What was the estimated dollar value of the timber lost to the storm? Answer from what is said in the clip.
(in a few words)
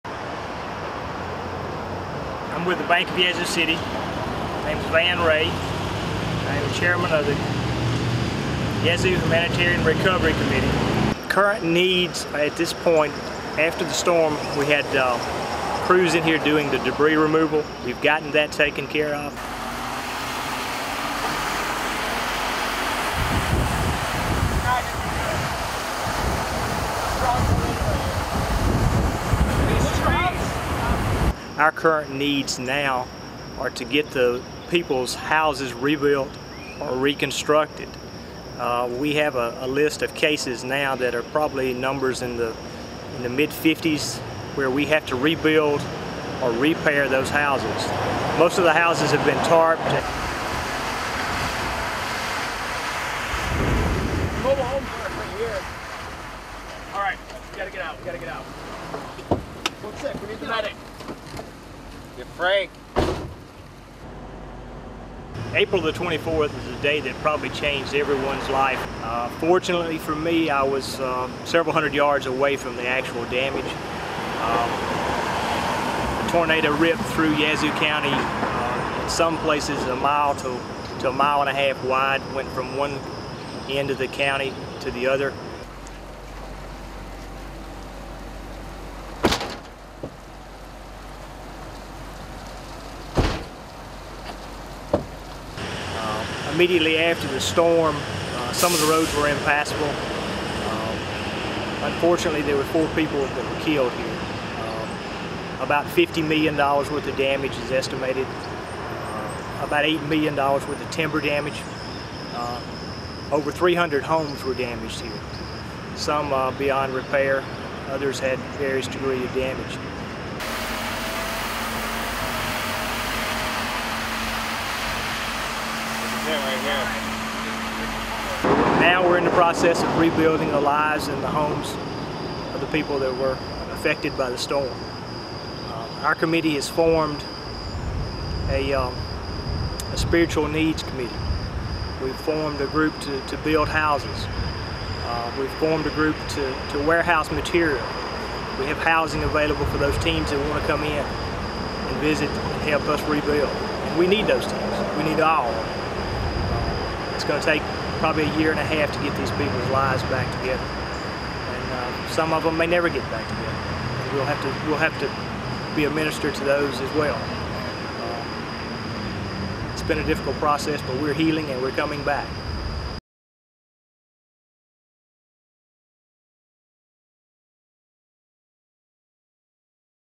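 $8 million.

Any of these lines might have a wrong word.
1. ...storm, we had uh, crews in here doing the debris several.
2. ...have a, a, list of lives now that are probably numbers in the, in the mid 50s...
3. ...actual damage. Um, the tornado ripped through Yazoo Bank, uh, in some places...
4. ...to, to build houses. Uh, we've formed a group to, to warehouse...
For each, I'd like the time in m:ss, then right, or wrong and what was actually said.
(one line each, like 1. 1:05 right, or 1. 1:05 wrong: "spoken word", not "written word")
1. 0:13 wrong: "removal", not "several"
2. 0:39 wrong: "cases", not "lives"
3. 1:12 wrong: "County", not "Bank"
4. 2:23 right.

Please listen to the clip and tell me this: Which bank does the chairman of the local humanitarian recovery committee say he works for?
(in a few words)
Bank of Yazoo City.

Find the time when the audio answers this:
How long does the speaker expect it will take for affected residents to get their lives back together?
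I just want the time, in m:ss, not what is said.
2:38.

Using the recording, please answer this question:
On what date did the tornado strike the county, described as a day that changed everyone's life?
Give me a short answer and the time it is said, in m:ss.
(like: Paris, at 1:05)
April 24th, at 1:05.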